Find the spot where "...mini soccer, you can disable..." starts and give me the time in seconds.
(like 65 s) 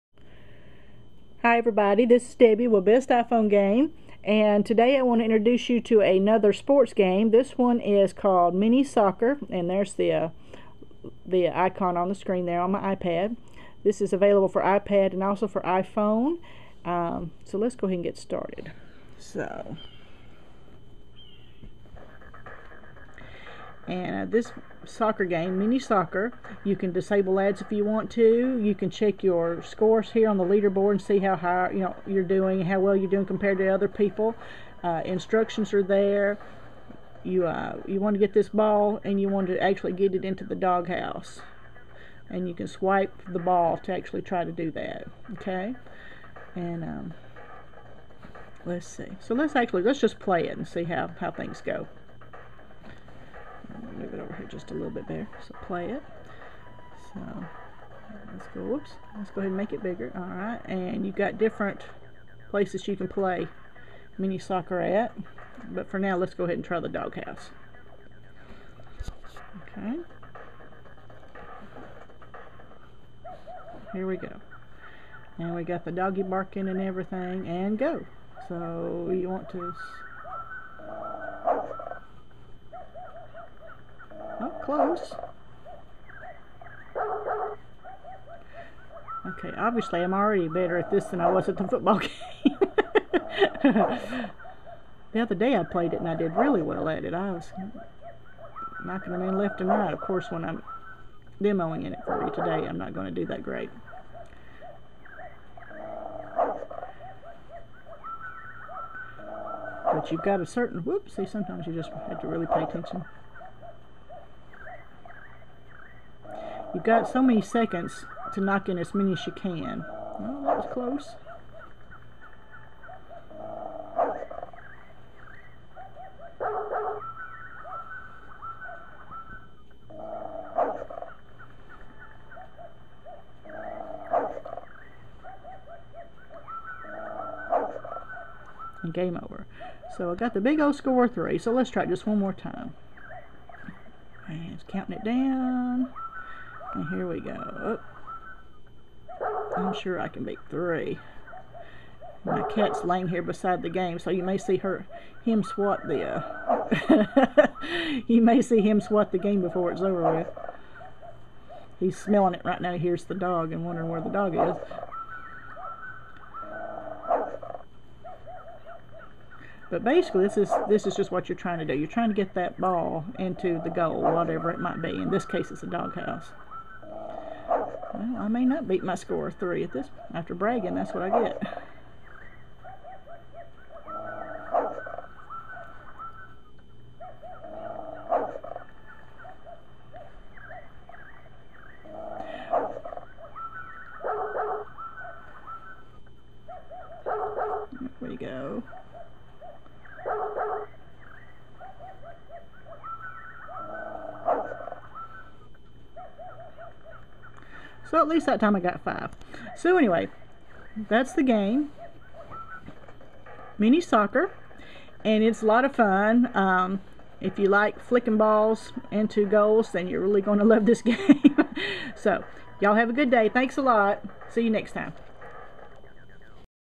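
25 s.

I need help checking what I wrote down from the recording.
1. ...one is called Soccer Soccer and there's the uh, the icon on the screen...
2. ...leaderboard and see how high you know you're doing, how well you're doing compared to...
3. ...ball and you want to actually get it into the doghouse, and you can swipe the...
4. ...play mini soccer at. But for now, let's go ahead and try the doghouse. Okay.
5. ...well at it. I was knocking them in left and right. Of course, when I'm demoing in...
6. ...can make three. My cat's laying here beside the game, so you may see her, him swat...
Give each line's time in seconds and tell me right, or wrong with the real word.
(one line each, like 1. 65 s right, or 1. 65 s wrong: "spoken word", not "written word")
1. 7 s wrong: "Mini", not "Soccer"
2. 30 s right
3. 38 s right
4. 63 s right
5. 96 s right
6. 150 s right.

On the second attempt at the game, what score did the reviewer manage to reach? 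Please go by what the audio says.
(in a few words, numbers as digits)
5.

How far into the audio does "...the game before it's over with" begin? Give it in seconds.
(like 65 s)
159 s.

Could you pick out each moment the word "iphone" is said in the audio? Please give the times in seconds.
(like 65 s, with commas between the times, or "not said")
3 s, 15 s.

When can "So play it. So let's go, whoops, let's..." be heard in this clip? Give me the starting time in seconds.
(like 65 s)
55 s.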